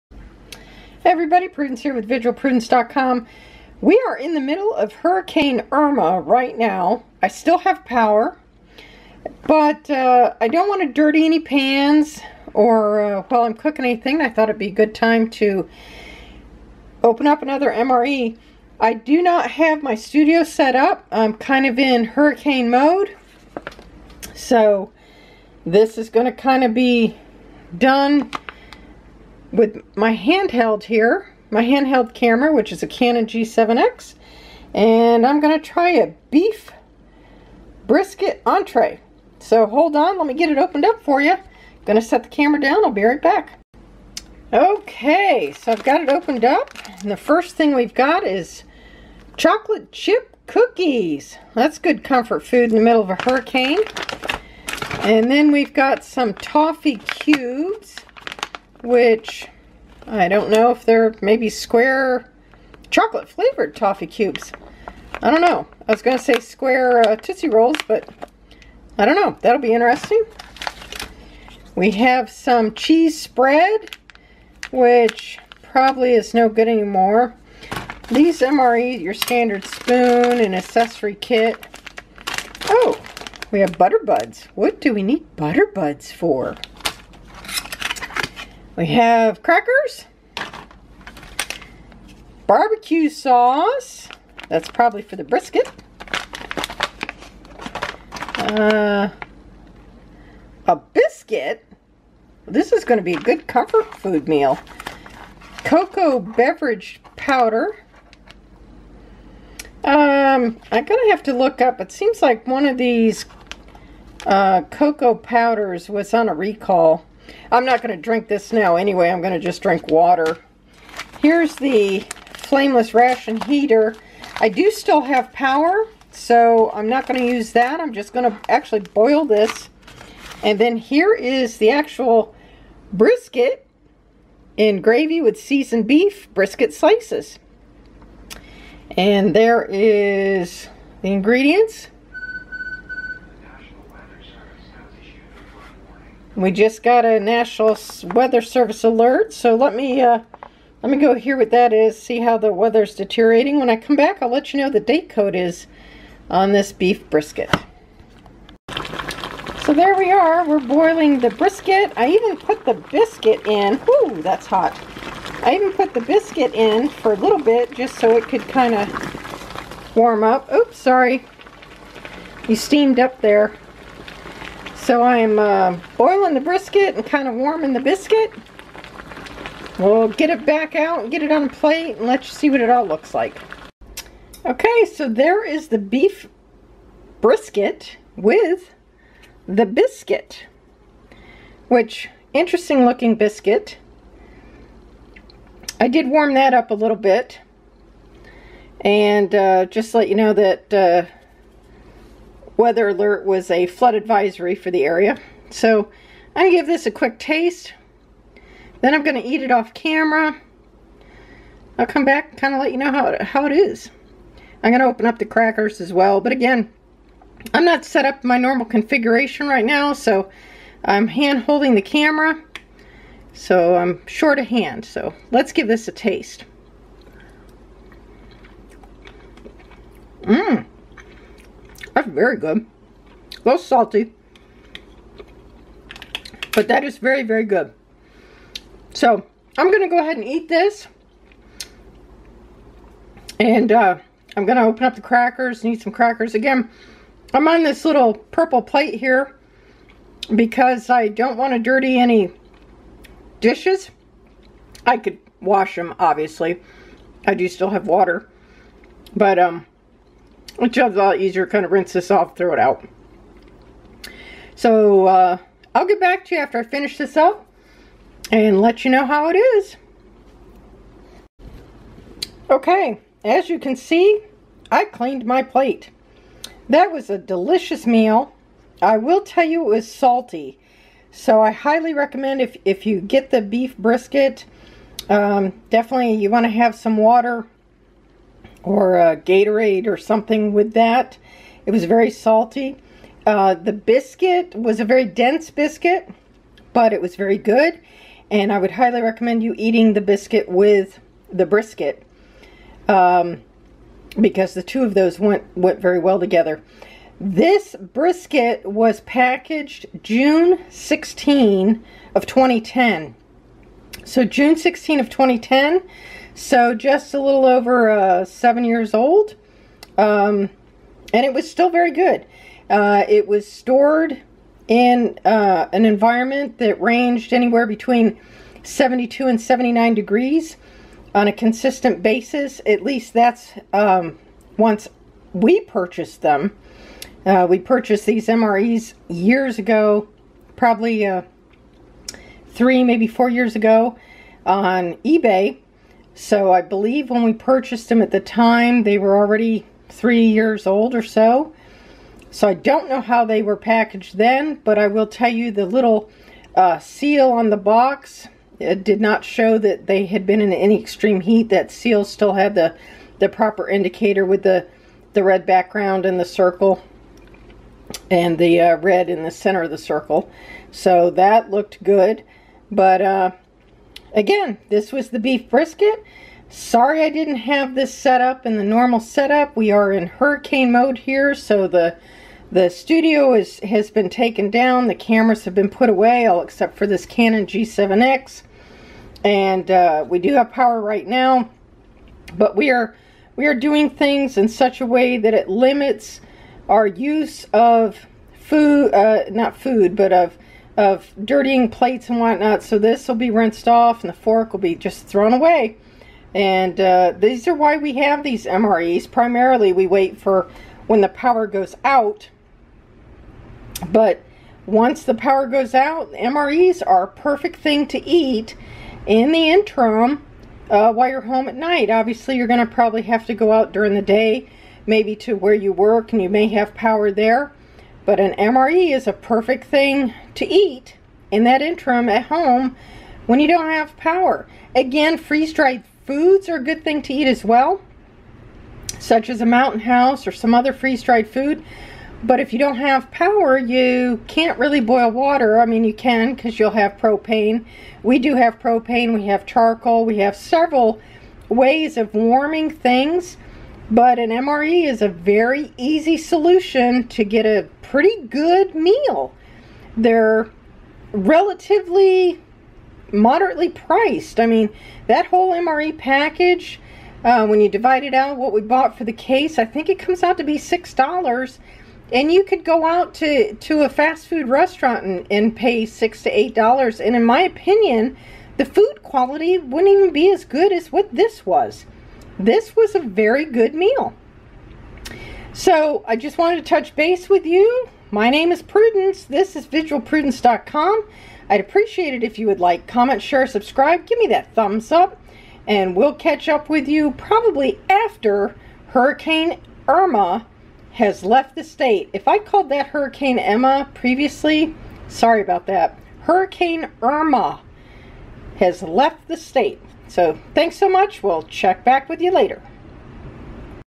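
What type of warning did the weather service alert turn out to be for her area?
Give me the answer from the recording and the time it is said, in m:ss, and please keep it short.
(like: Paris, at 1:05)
flood advisory, at 3:23.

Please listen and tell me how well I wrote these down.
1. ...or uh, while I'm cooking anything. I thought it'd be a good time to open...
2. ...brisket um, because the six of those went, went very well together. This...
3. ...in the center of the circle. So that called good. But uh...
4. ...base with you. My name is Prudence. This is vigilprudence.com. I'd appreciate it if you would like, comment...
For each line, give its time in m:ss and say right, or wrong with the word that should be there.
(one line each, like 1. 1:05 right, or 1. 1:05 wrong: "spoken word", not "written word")
1. 0:12 right
2. 5:01 wrong: "two", not "six"
3. 6:09 wrong: "looked", not "called"
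4. 8:06 right.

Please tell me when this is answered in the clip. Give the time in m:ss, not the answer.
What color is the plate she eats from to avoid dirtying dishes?
4:08.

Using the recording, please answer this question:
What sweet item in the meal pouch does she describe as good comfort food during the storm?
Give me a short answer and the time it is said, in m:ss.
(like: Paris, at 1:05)
chocolate chip cookies, at 0:49.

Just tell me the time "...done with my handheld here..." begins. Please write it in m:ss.
0:27.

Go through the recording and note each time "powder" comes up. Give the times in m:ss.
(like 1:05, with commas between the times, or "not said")
1:47, 1:55.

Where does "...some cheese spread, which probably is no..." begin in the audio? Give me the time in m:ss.
1:12.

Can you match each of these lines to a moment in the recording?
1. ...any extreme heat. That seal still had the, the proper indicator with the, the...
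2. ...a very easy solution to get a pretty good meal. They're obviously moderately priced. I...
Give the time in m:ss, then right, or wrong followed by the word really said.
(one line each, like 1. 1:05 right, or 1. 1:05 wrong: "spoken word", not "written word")
1. 6:00 right
2. 7:35 wrong: "relatively", not "obviously".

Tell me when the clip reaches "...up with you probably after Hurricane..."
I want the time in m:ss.
8:16.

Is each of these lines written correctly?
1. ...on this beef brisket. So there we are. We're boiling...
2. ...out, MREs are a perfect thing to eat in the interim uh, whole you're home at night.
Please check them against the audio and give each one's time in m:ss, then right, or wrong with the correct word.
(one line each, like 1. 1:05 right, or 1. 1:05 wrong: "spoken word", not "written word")
1. 2:36 right
2. 6:55 wrong: "while", not "whole".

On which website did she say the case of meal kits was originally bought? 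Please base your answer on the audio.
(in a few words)
eBay.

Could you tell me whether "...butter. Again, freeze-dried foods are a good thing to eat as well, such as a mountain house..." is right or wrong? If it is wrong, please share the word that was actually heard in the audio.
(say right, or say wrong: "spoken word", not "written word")
wrong: "power", not "butter".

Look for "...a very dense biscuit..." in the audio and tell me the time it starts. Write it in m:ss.
4:54.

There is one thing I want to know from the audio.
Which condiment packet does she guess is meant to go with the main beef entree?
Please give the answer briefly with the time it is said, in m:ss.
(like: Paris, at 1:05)
barbecue sauce, at 1:32.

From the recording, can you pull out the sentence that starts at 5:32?
At least that's um, once we purchased them.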